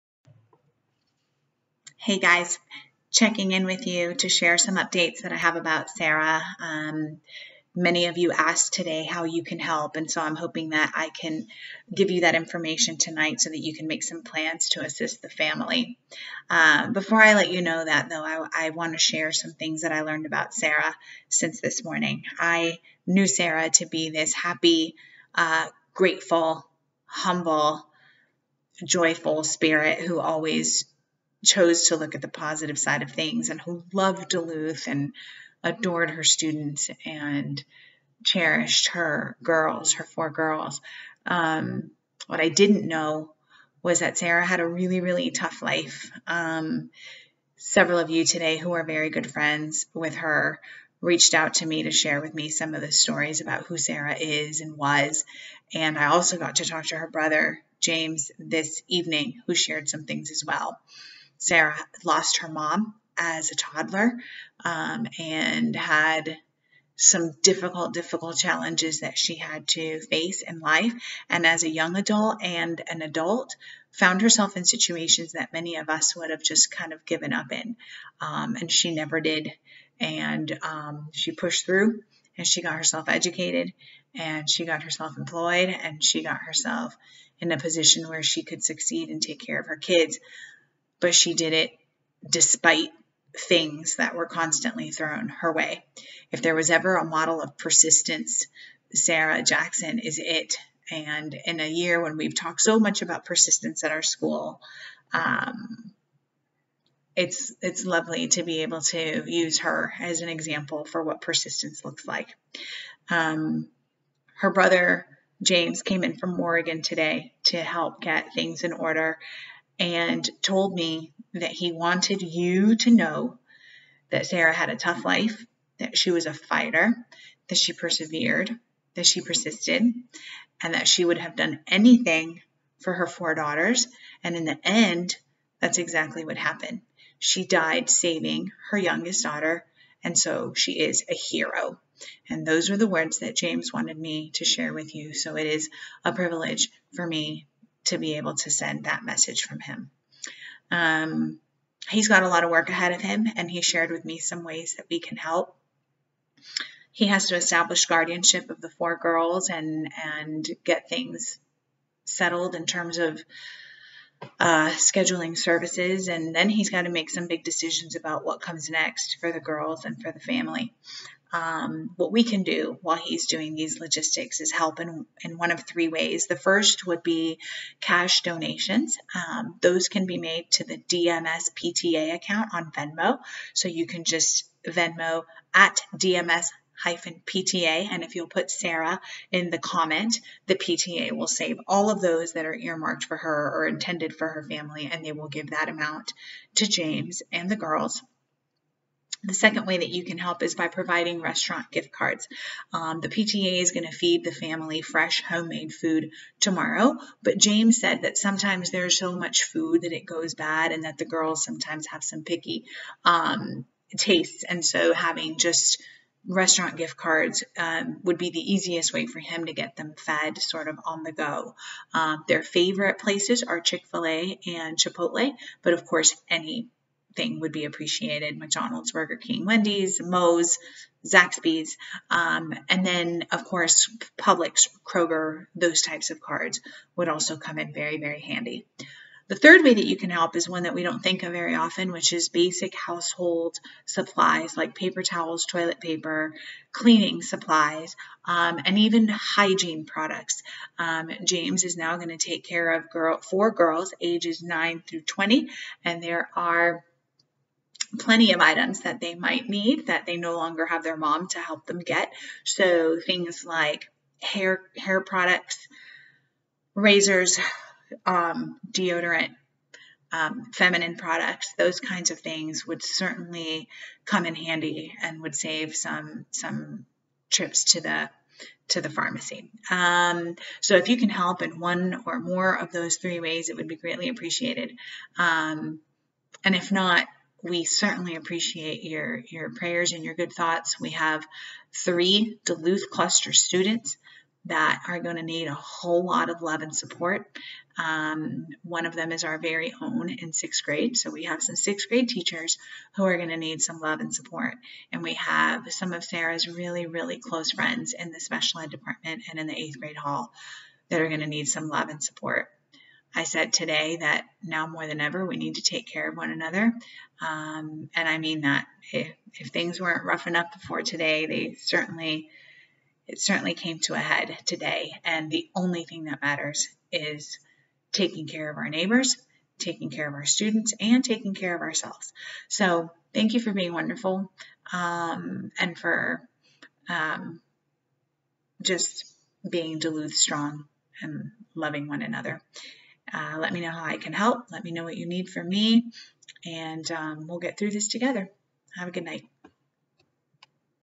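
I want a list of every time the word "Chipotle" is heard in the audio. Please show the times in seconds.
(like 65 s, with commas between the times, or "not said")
224 s.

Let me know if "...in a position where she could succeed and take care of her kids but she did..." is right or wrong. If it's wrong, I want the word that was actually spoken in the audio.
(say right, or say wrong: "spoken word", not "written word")
right.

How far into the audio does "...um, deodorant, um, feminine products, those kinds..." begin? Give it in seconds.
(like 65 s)
268 s.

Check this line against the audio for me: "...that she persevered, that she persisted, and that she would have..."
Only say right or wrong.
right.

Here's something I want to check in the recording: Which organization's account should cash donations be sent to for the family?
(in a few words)
DMS PTA.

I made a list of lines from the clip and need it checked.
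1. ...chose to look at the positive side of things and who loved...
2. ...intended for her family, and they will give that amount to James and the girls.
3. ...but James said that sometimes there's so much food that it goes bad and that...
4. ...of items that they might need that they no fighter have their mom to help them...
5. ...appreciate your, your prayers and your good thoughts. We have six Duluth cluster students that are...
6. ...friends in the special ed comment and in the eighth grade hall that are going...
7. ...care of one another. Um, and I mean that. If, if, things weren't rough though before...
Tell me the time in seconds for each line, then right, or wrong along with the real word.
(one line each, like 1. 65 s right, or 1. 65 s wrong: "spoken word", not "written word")
1. 31 s right
2. 193 s right
3. 207 s right
4. 258 s wrong: "longer", not "fighter"
5. 288 s wrong: "three", not "six"
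6. 307 s wrong: "department", not "comment"
7. 315 s wrong: "enough", not "though".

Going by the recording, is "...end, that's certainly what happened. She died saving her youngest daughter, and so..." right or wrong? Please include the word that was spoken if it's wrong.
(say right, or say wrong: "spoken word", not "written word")
wrong: "exactly", not "certainly".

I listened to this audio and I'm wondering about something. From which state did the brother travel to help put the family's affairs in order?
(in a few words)
Oregon.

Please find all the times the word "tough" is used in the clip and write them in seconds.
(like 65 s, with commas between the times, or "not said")
45 s, 124 s.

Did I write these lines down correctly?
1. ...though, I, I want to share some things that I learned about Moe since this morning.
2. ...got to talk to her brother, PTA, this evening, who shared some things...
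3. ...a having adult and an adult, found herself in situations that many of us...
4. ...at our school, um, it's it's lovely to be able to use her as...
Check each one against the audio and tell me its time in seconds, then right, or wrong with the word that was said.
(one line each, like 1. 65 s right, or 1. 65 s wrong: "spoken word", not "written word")
1. 18 s wrong: "Sarah", not "Moe"
2. 56 s wrong: "James", not "PTA"
3. 71 s wrong: "young", not "having"
4. 103 s right.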